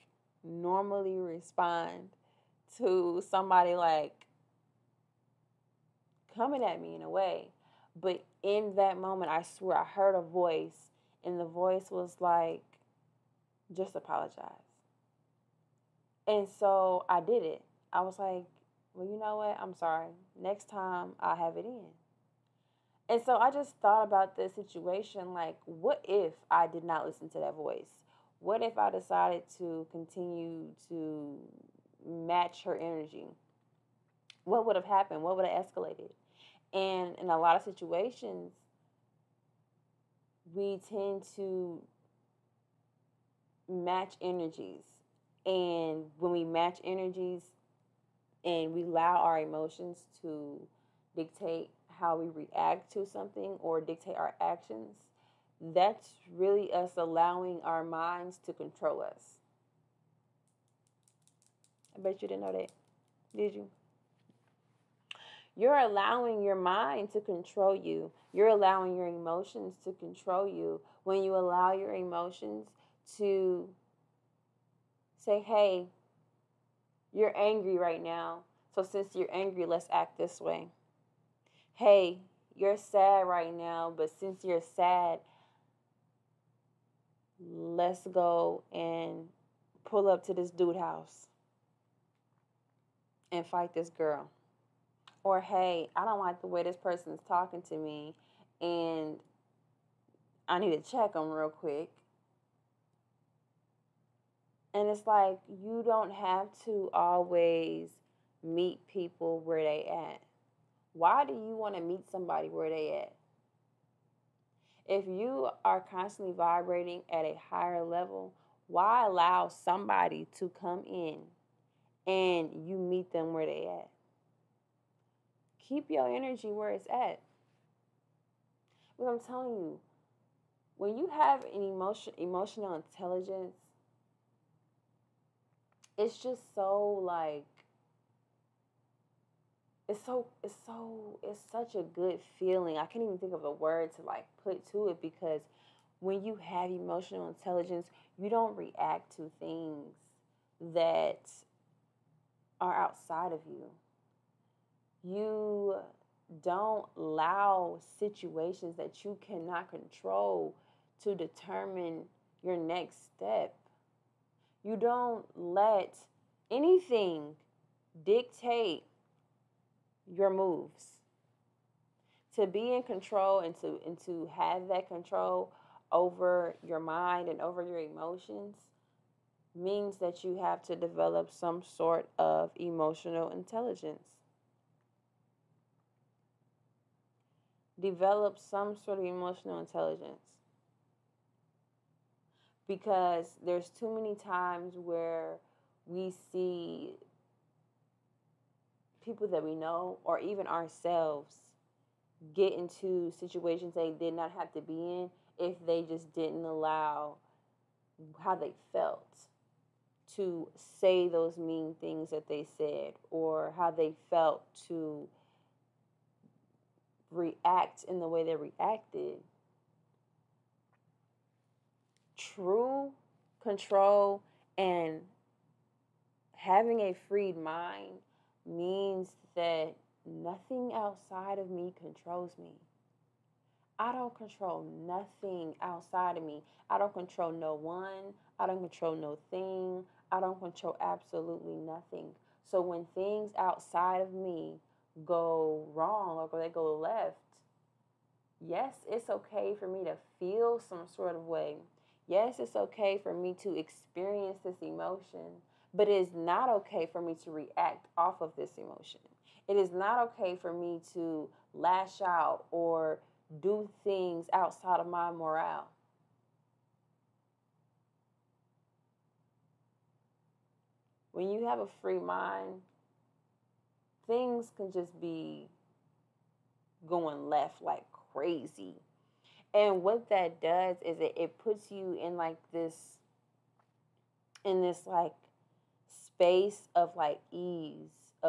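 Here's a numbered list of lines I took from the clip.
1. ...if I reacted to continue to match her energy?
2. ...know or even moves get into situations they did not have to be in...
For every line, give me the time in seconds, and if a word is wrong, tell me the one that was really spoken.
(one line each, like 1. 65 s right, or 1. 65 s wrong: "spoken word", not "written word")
1. 28 s wrong: "decided", not "reacted"
2. 199 s wrong: "ourselves", not "moves".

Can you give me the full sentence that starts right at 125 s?
Keep your energy where it's at.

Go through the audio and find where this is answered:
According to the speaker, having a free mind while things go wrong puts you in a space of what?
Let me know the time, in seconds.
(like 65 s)
287 s.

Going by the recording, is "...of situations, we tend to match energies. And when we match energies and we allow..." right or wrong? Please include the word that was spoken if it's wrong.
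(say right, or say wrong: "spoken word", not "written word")
right.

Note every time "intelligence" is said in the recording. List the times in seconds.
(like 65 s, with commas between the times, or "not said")
132 s, 147 s, 183 s, 189 s.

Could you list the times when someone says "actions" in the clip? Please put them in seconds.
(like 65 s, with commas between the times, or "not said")
54 s.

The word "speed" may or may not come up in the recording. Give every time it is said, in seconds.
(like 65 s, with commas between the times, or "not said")
not said.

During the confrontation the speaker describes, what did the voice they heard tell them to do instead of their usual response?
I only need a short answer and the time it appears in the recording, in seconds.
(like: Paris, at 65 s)
just apologize, at 13 s.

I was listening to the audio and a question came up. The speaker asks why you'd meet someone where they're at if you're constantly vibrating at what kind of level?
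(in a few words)
a higher level.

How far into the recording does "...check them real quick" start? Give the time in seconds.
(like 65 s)
100 s.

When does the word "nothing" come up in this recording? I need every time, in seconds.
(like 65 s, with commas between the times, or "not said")
230 s, 234 s, 241 s.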